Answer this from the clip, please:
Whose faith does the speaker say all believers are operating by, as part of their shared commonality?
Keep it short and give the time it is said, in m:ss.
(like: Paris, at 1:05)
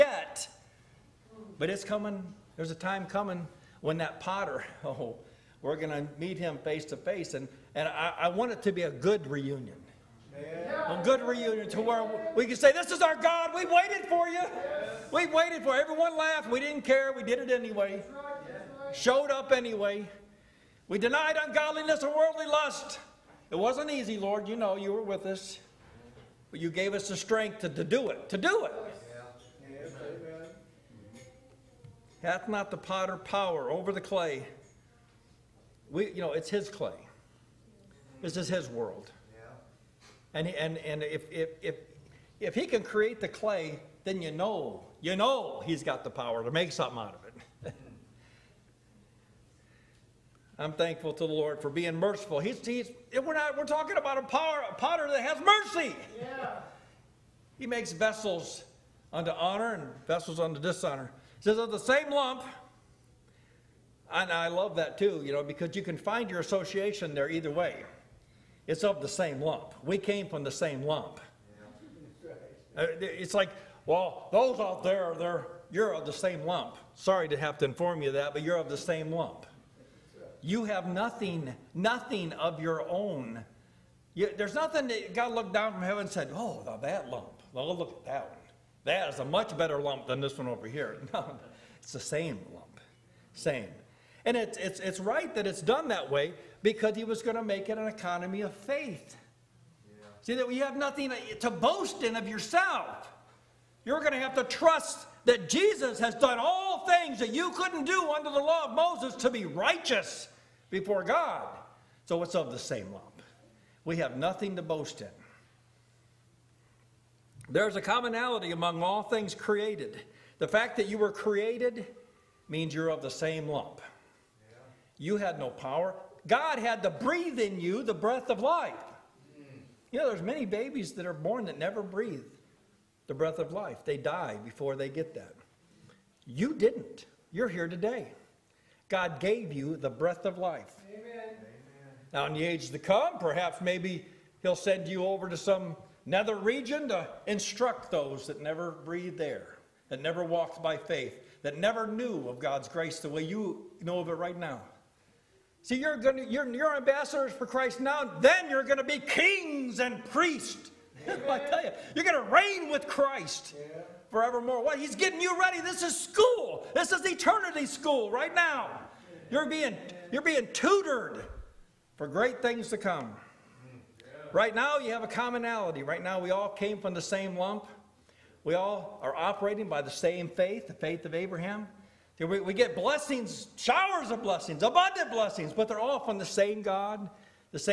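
Abraham, at 3:00.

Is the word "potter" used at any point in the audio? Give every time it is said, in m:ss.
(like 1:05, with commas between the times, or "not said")
0:04, 0:32, 0:54.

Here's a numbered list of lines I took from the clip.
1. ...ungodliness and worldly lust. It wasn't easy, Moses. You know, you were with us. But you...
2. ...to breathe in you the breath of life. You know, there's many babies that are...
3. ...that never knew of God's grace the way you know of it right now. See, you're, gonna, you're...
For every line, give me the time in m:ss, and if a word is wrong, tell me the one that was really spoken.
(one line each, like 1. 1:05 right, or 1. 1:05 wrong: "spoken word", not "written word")
1. 0:21 wrong: "Lord", not "Moses"
2. 2:06 right
3. 2:31 right.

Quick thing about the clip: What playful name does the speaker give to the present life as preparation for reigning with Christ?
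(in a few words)
Eternity school.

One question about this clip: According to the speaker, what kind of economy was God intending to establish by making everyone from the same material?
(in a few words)
An economy of faith.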